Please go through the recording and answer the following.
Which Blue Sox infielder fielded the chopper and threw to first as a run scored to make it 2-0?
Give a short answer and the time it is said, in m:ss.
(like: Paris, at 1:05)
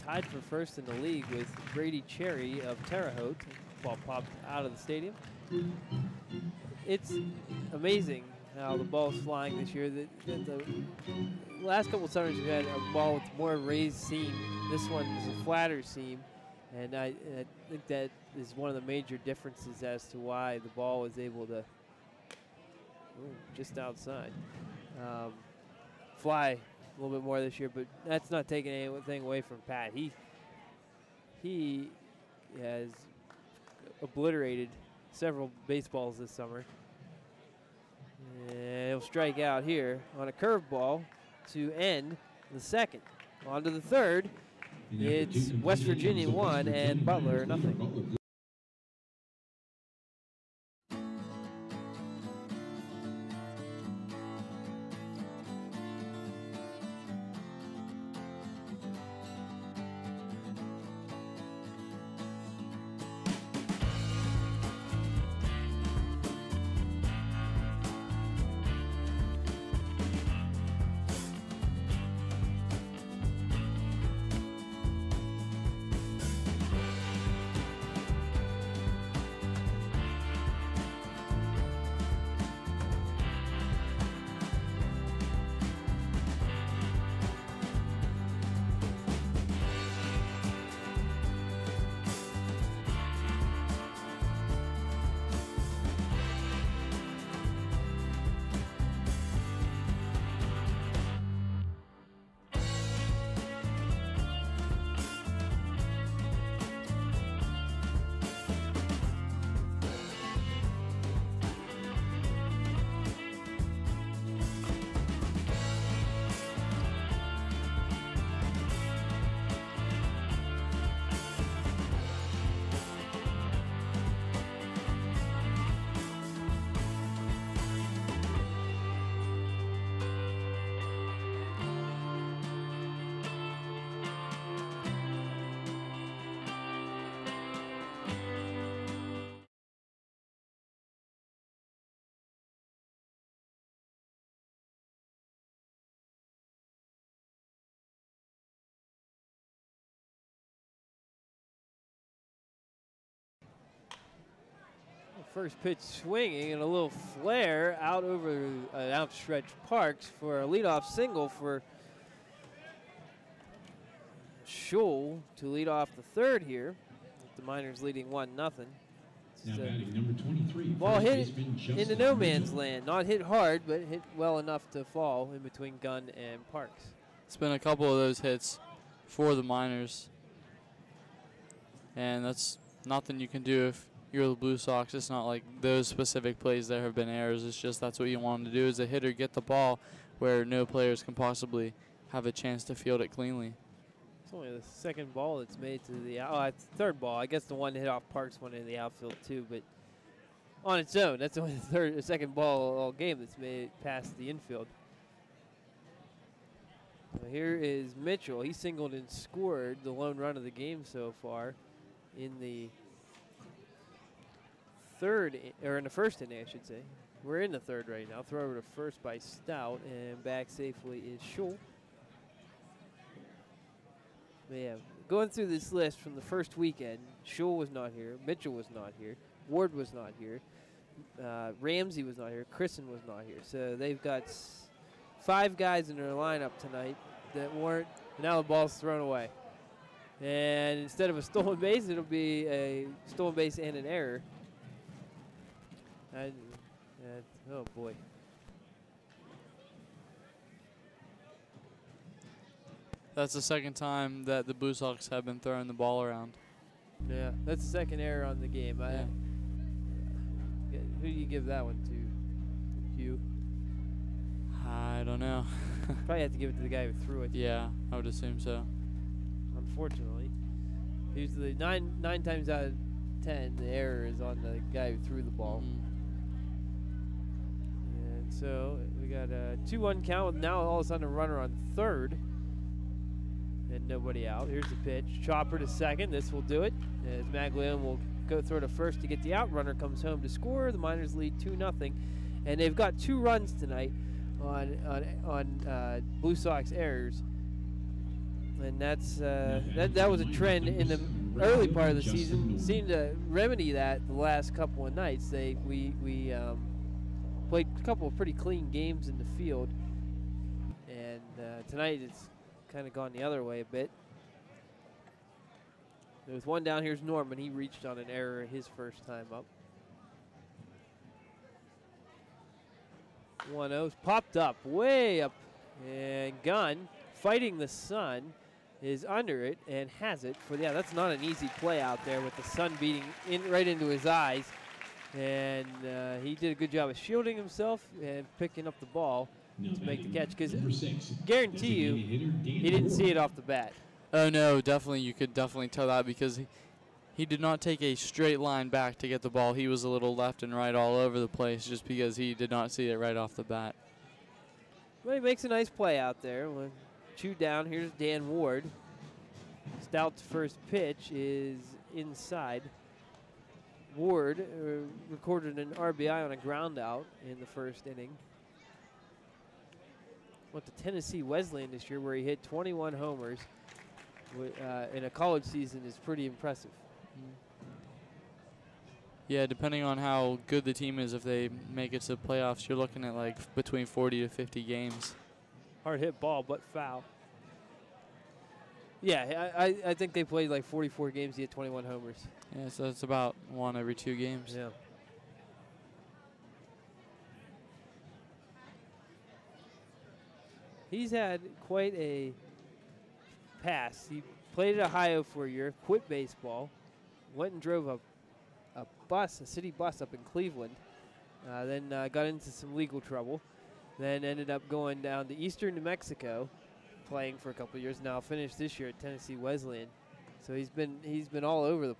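Maglione, at 4:47.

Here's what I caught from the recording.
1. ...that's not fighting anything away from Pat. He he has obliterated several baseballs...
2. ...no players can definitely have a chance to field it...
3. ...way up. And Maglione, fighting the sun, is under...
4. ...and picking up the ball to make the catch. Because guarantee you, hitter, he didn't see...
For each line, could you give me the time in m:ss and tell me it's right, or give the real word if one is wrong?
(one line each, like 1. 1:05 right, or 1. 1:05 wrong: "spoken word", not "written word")
1. 0:28 wrong: "taking", not "fighting"
2. 3:10 wrong: "possibly", not "definitely"
3. 5:24 wrong: "Gunn", not "Maglione"
4. 5:38 right.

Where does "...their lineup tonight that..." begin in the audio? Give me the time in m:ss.
3:55.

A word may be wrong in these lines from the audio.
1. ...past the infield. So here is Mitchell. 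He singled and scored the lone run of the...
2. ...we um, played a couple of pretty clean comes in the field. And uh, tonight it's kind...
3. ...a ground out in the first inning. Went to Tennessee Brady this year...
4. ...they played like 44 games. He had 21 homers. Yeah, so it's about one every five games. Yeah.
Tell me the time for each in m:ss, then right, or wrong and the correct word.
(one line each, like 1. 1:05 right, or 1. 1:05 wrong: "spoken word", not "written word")
1. 3:23 right
2. 5:06 wrong: "games", not "comes"
3. 6:06 wrong: "Wesleyan", not "Brady"
4. 6:30 wrong: "two", not "five".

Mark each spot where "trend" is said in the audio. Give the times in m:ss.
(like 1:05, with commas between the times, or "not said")
5:00.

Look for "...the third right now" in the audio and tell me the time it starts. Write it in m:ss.
3:37.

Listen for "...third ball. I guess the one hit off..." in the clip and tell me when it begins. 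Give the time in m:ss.
3:16.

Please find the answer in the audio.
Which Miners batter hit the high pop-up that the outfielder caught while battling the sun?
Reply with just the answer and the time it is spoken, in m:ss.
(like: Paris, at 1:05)
Norman, at 5:17.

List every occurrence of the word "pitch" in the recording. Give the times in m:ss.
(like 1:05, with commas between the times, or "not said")
2:35, 4:44, 6:00.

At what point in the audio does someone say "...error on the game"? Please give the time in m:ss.
4:17.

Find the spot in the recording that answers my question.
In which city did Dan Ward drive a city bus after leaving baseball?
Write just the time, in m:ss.
6:50.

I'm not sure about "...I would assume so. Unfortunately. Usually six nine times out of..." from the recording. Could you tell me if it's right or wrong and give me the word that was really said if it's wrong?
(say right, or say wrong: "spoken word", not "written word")
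wrong: "nine", not "six".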